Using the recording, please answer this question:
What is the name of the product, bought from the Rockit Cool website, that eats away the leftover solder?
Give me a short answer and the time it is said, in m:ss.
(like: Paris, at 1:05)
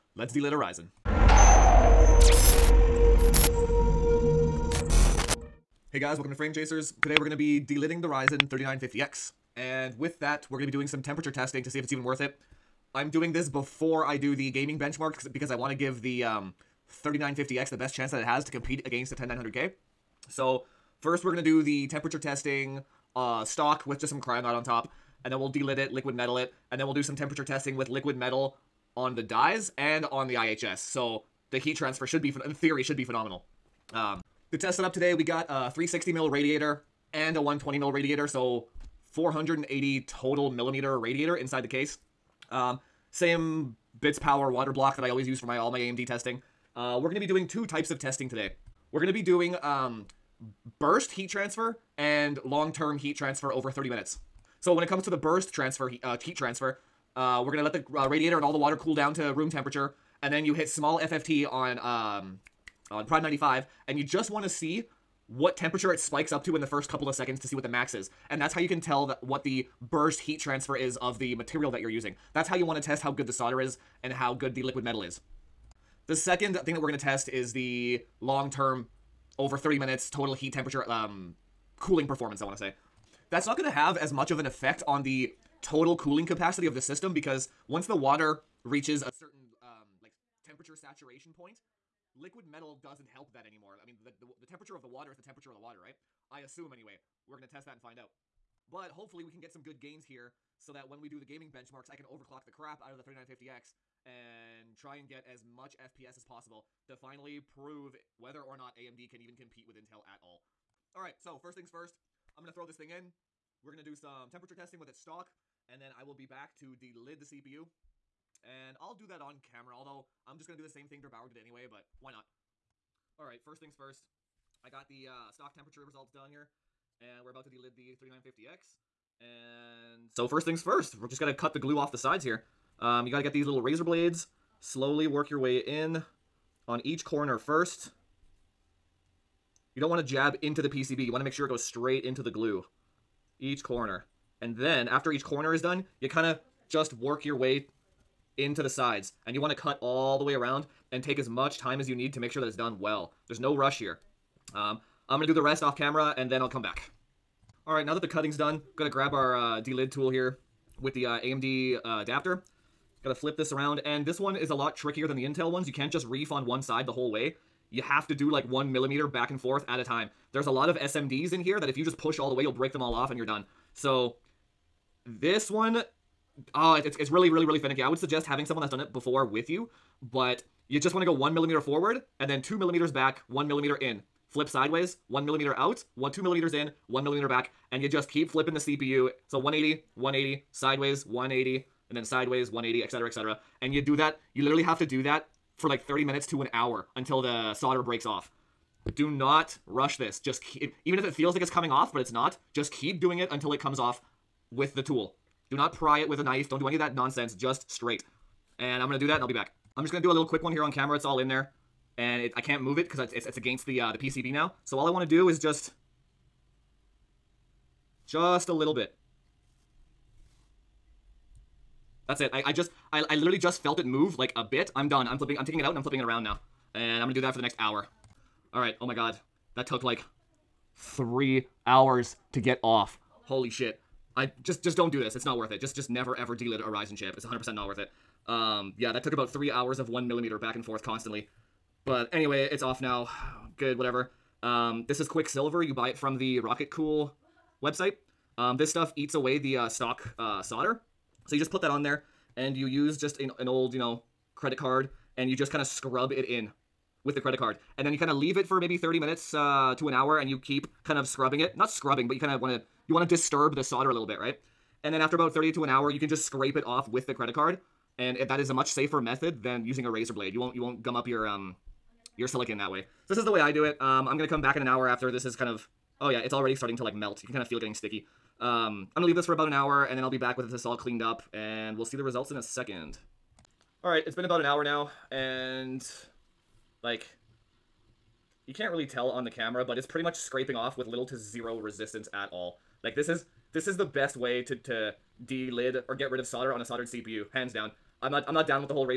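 Quicksilver, at 4:05.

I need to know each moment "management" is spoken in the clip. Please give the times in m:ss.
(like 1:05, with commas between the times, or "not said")
not said.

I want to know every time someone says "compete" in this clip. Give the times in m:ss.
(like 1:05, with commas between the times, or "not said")
0:18, 1:49.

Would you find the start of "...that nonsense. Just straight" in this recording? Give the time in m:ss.
3:26.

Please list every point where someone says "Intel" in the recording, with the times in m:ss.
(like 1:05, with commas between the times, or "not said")
1:49, 2:45.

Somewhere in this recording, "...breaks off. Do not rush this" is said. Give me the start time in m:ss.
3:17.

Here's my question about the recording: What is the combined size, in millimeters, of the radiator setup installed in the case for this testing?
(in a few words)
480.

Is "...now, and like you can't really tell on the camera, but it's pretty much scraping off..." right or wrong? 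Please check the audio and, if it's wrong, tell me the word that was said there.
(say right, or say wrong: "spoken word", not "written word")
right.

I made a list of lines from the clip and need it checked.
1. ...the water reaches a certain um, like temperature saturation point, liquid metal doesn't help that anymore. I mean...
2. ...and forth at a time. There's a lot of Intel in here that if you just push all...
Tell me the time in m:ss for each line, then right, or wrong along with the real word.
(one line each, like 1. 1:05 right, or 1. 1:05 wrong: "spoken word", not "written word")
1. 1:27 right
2. 2:49 wrong: "SMDs", not "Intel".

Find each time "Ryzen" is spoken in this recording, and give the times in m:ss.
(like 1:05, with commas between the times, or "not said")
0:08, 3:56.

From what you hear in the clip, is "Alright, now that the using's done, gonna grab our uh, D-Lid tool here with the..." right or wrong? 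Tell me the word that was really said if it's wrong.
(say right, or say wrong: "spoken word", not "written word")
wrong: "cutting", not "using".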